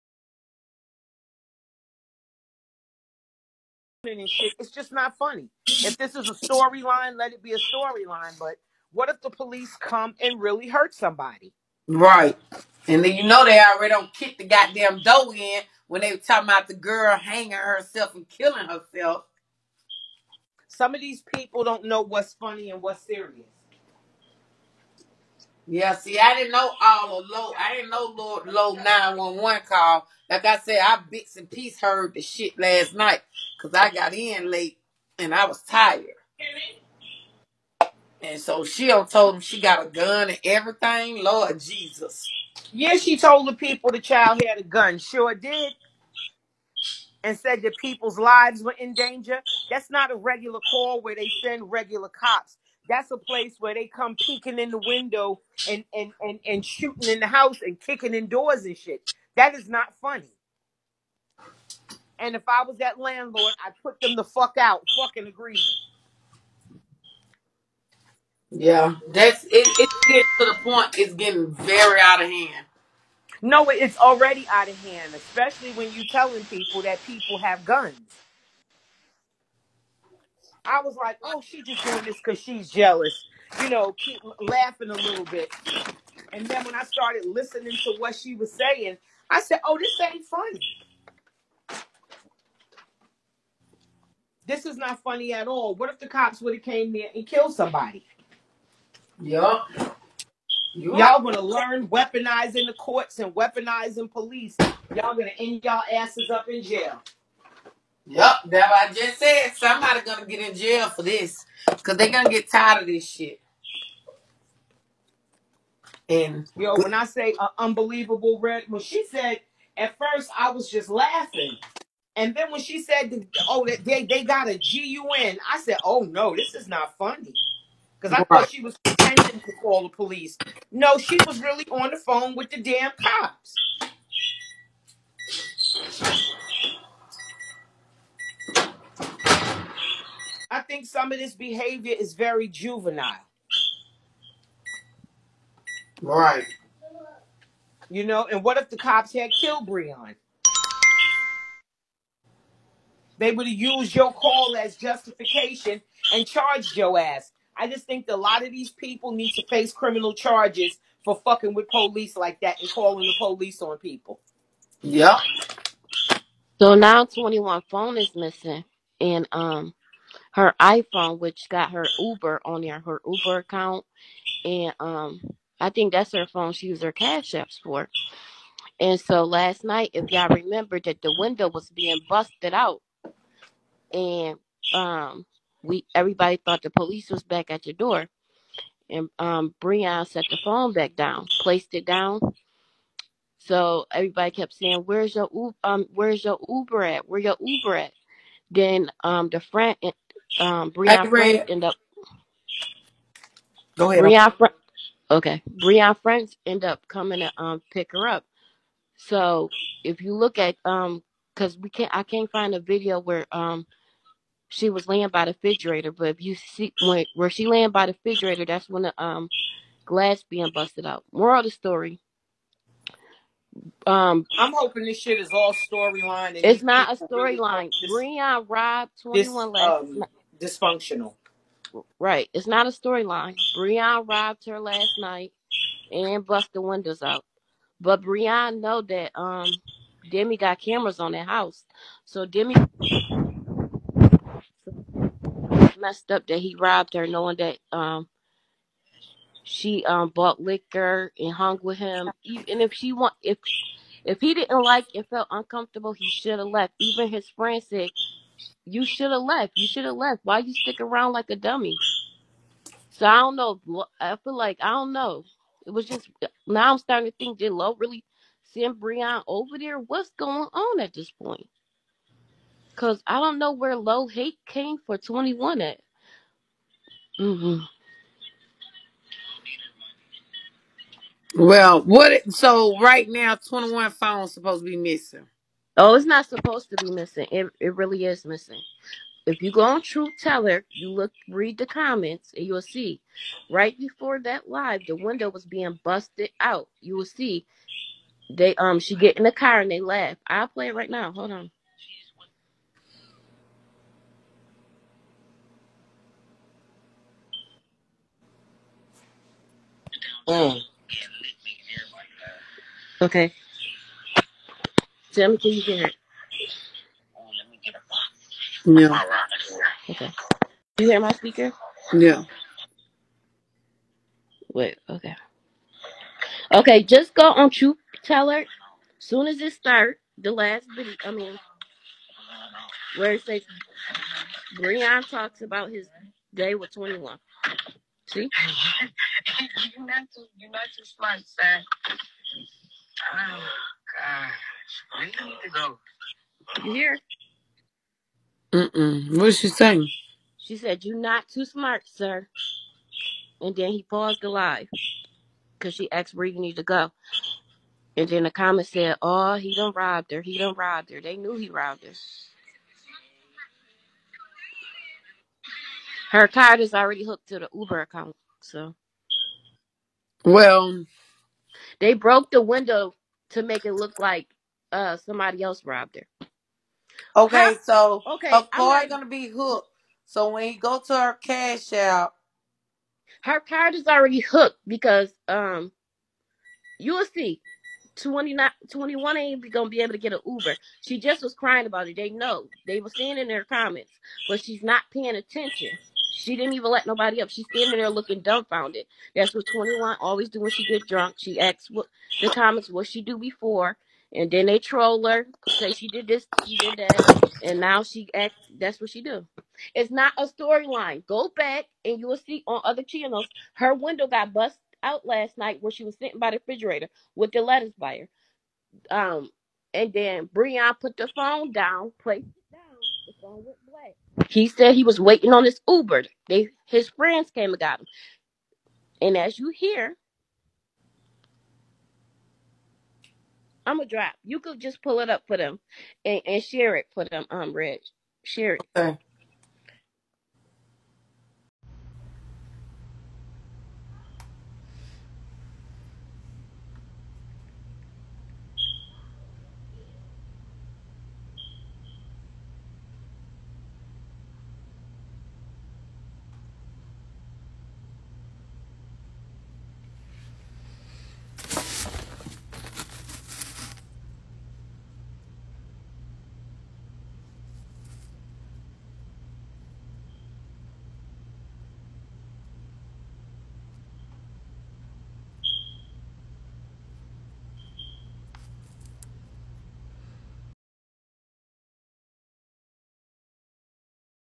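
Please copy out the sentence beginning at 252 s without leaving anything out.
Even if she want if if he didn't like and felt uncomfortable, he should have left.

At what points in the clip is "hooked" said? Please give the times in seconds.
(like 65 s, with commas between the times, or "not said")
367 s, 379 s, 384 s.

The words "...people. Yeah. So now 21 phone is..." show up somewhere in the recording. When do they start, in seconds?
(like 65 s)
163 s.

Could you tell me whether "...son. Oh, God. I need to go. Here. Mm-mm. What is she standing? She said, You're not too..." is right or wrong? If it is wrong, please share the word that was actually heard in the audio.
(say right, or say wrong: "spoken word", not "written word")
wrong: "saying", not "standing".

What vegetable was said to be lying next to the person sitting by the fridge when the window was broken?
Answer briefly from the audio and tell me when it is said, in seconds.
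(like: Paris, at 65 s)
Lettuce, at 417 s.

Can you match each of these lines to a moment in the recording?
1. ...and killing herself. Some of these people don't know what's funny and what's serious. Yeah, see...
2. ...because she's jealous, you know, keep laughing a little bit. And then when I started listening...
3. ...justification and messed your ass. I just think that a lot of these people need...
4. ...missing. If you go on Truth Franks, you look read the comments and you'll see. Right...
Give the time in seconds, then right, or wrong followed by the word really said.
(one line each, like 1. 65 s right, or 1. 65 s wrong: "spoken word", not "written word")
1. 18 s right
2. 82 s right
3. 154 s wrong: "charged", not "messed"
4. 288 s wrong: "Teller", not "Franks".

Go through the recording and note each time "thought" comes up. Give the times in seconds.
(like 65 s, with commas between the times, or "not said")
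128 s, 186 s.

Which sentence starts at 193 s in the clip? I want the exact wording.
So everybody kept saying, "Where's your um, Where's your Uber at?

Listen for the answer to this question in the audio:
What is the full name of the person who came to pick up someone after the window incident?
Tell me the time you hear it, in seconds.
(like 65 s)
205 s.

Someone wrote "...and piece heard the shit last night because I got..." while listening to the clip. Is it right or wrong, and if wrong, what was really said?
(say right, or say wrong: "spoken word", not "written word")
right.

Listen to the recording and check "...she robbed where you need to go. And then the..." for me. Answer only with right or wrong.
wrong.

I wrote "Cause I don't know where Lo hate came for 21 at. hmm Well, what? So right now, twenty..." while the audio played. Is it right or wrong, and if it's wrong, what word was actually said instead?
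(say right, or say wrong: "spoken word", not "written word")
right.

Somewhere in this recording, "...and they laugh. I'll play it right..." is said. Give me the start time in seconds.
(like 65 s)
299 s.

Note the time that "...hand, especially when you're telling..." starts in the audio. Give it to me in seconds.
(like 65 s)
74 s.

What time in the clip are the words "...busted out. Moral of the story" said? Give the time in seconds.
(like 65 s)
220 s.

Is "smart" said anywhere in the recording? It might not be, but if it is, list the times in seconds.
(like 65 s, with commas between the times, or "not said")
340 s, 351 s.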